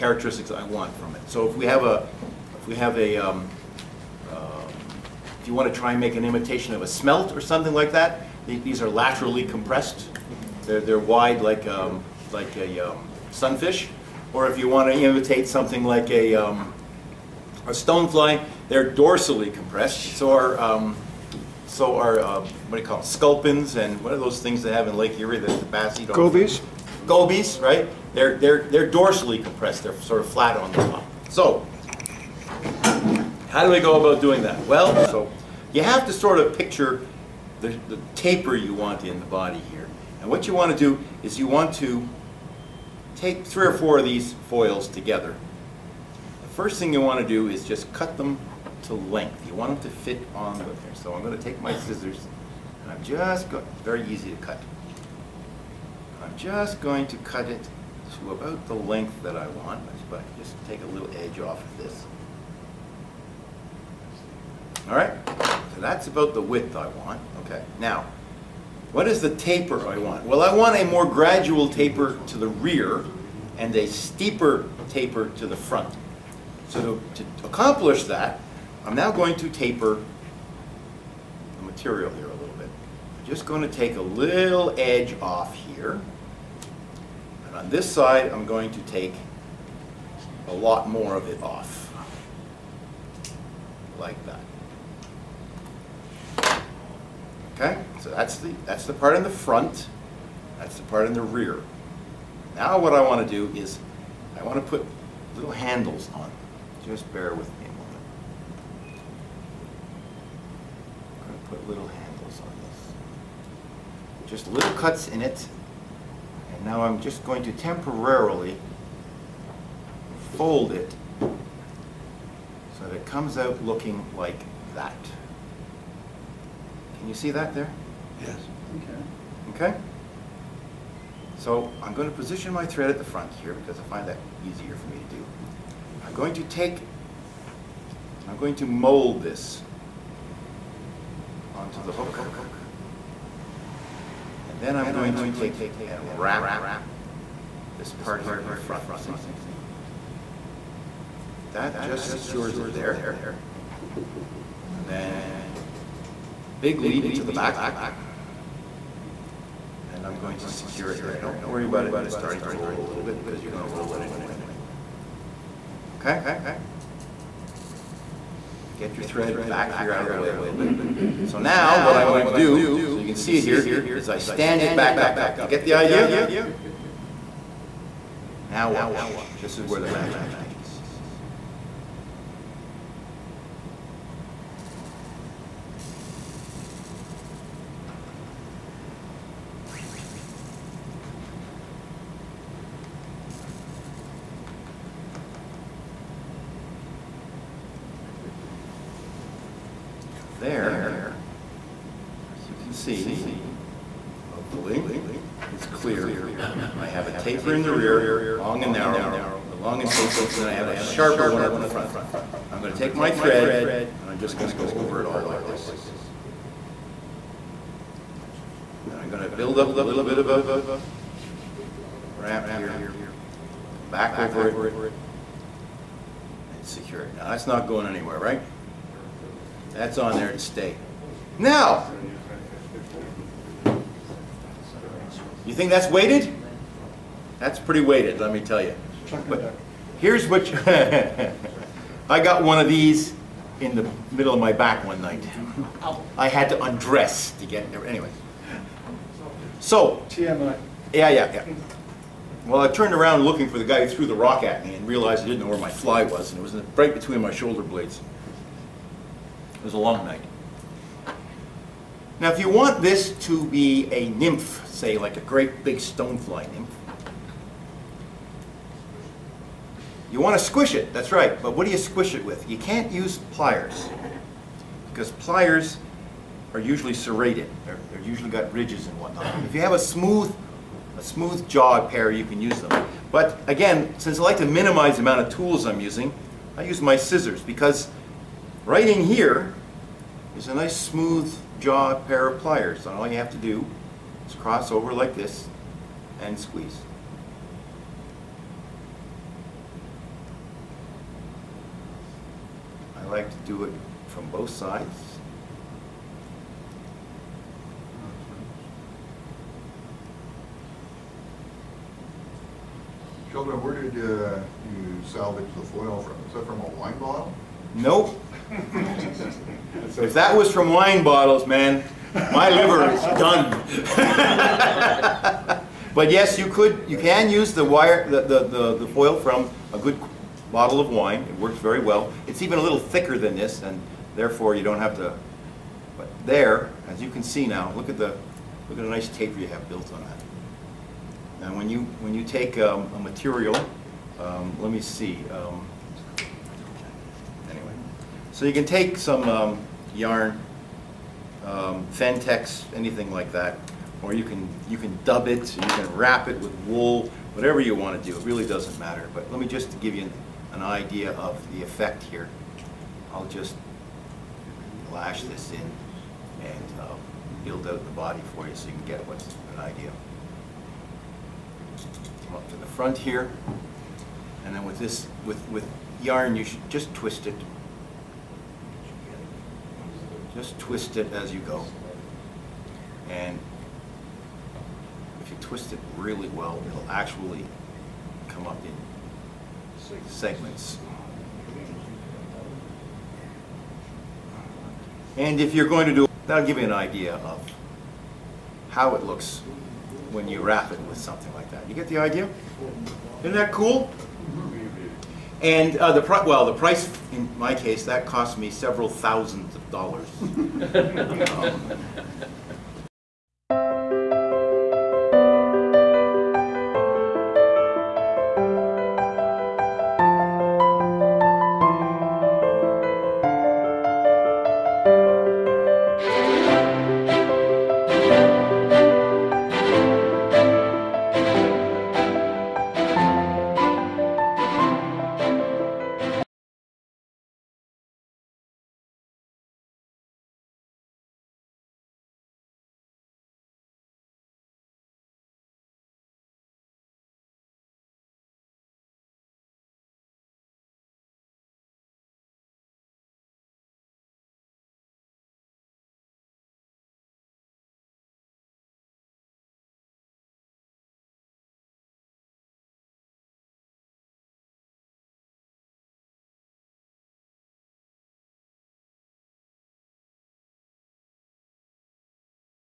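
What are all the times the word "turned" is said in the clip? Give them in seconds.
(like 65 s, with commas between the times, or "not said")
252 s.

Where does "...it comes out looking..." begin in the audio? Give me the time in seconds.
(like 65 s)
122 s.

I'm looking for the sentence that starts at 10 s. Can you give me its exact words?
They're, they're wide like, um, like a um, sunfish.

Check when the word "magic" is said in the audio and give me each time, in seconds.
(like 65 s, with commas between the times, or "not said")
179 s.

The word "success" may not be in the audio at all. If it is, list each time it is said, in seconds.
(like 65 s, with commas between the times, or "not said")
not said.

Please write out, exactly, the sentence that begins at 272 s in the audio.
You can't use pliers because pliers are usually serrated.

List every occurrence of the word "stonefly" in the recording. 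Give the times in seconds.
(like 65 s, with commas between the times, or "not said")
17 s, 265 s.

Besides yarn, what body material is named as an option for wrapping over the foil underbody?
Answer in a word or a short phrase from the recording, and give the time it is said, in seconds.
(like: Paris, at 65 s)
Fentex, at 351 s.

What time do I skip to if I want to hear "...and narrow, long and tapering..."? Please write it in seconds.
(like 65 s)
208 s.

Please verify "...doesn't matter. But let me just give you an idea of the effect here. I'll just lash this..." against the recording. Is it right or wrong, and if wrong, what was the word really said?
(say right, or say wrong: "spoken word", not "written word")
right.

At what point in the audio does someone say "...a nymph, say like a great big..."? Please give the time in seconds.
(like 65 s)
263 s.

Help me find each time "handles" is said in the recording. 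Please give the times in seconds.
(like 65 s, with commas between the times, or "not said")
105 s, 111 s.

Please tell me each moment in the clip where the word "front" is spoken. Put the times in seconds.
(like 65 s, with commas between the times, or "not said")
75 s, 99 s, 133 s, 148 s, 211 s, 372 s.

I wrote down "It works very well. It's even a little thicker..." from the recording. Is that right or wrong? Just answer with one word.
right.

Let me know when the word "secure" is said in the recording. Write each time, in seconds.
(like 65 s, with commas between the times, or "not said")
152 s, 160 s, 226 s.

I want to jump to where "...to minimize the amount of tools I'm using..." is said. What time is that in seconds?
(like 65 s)
284 s.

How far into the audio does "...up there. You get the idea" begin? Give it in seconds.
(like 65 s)
174 s.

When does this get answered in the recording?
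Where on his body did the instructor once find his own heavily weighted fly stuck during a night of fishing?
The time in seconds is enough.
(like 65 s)
256 s.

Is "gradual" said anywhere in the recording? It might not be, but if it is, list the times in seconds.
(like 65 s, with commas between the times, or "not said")
71 s.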